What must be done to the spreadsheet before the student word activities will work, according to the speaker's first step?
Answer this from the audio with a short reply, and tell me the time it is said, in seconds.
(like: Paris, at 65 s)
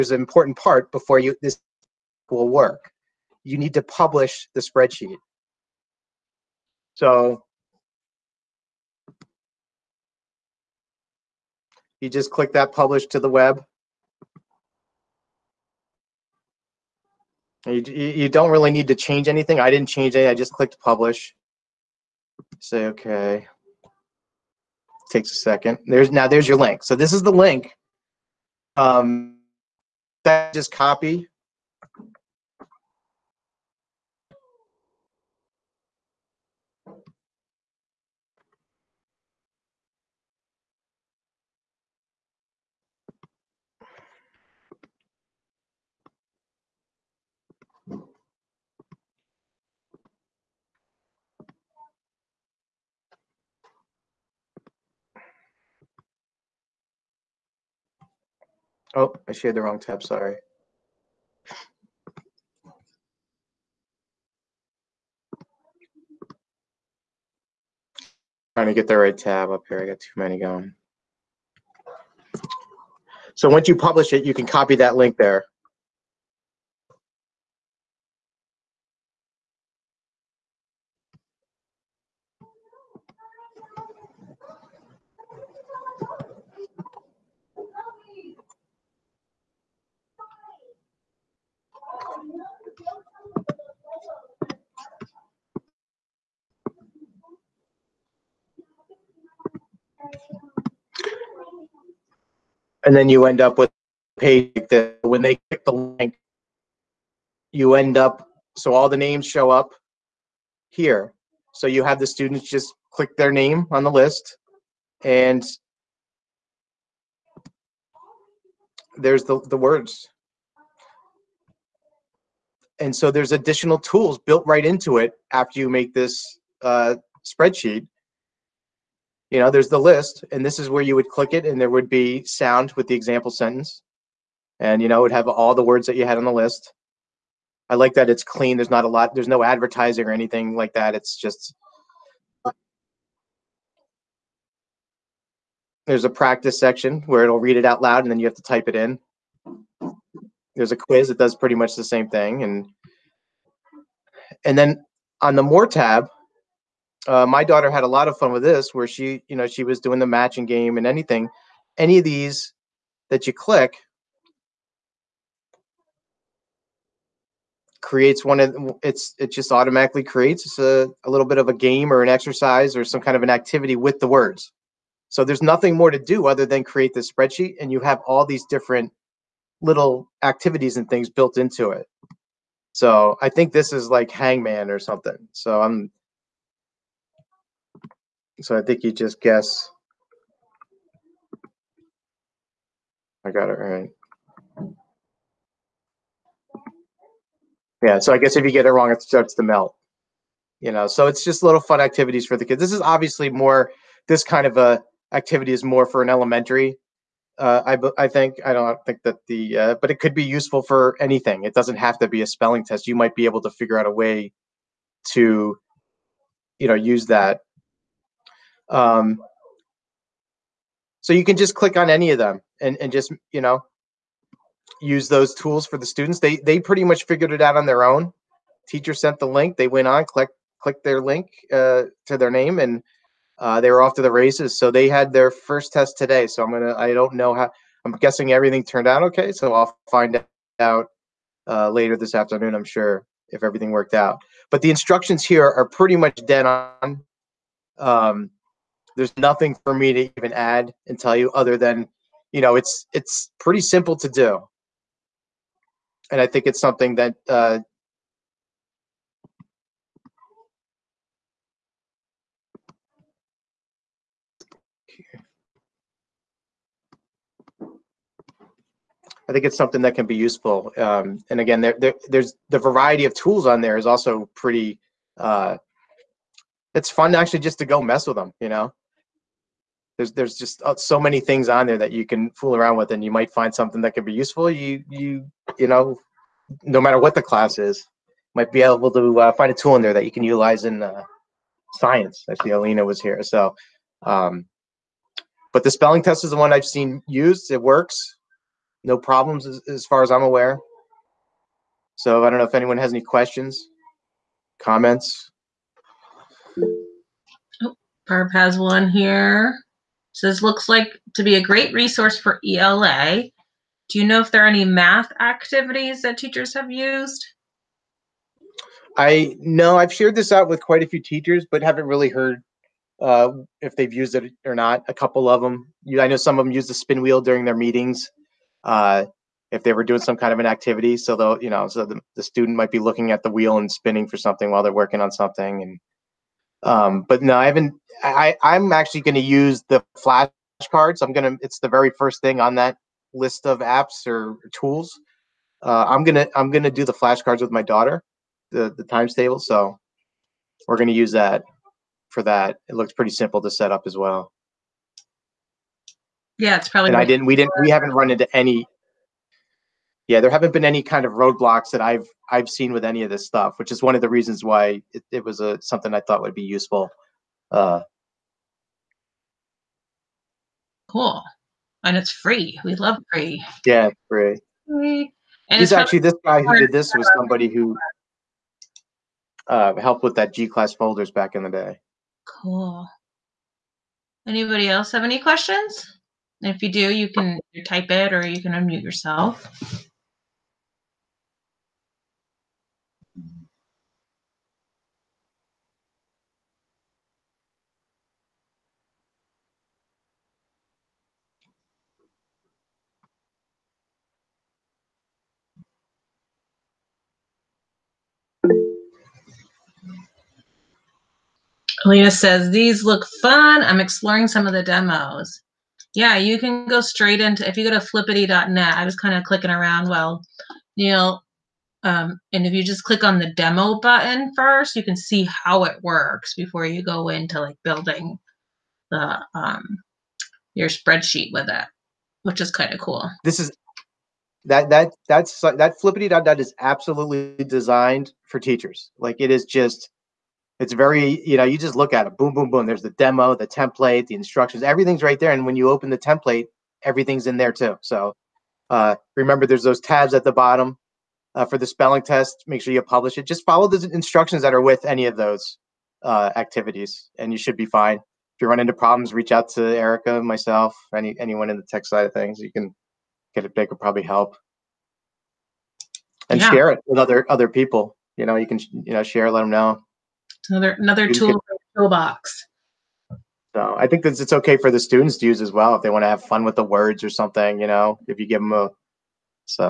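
Publish to the web, at 12 s.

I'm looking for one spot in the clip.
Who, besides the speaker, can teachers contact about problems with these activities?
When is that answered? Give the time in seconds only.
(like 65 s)
459 s.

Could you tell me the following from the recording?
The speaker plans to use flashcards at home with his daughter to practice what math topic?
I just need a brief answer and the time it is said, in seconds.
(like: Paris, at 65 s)
Times table, at 348 s.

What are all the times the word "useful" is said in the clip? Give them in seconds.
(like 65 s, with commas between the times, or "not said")
210 s, 270 s, 284 s, 366 s.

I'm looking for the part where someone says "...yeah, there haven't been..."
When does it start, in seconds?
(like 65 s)
360 s.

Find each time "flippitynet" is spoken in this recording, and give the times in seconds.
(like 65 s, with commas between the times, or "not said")
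417 s, 435 s.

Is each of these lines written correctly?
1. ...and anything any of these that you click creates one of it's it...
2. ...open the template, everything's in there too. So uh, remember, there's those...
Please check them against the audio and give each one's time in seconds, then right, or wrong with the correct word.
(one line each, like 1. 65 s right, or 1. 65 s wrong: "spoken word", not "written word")
1. 160 s right
2. 445 s right.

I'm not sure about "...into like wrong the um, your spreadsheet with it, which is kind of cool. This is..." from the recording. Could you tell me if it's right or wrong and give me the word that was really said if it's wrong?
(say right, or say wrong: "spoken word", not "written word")
wrong: "building", not "wrong".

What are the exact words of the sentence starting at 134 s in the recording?
And, you know, it would have all the words that you had on the list.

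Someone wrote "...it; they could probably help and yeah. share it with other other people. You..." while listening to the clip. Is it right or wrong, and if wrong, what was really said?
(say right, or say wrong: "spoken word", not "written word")
right.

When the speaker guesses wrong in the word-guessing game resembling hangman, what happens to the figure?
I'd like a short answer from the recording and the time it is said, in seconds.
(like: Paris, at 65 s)
It starts to melt, at 198 s.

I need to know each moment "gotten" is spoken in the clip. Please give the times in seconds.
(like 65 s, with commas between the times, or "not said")
not said.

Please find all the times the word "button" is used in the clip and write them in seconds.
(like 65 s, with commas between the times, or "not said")
423 s.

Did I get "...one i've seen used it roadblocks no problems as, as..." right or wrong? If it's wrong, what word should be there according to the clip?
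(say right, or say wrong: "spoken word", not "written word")
wrong: "works", not "roadblocks".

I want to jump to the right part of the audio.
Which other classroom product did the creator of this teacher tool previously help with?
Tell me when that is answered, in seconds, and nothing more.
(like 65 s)
380 s.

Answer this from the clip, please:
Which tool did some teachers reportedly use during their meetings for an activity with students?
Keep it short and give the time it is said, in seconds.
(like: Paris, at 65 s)
Spin wheel, at 326 s.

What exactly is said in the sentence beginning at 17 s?
You, you don't really need to change anything.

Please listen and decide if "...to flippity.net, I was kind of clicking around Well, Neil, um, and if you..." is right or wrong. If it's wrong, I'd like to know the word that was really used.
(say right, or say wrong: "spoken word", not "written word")
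right.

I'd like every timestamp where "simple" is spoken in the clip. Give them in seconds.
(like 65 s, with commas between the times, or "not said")
253 s, 353 s.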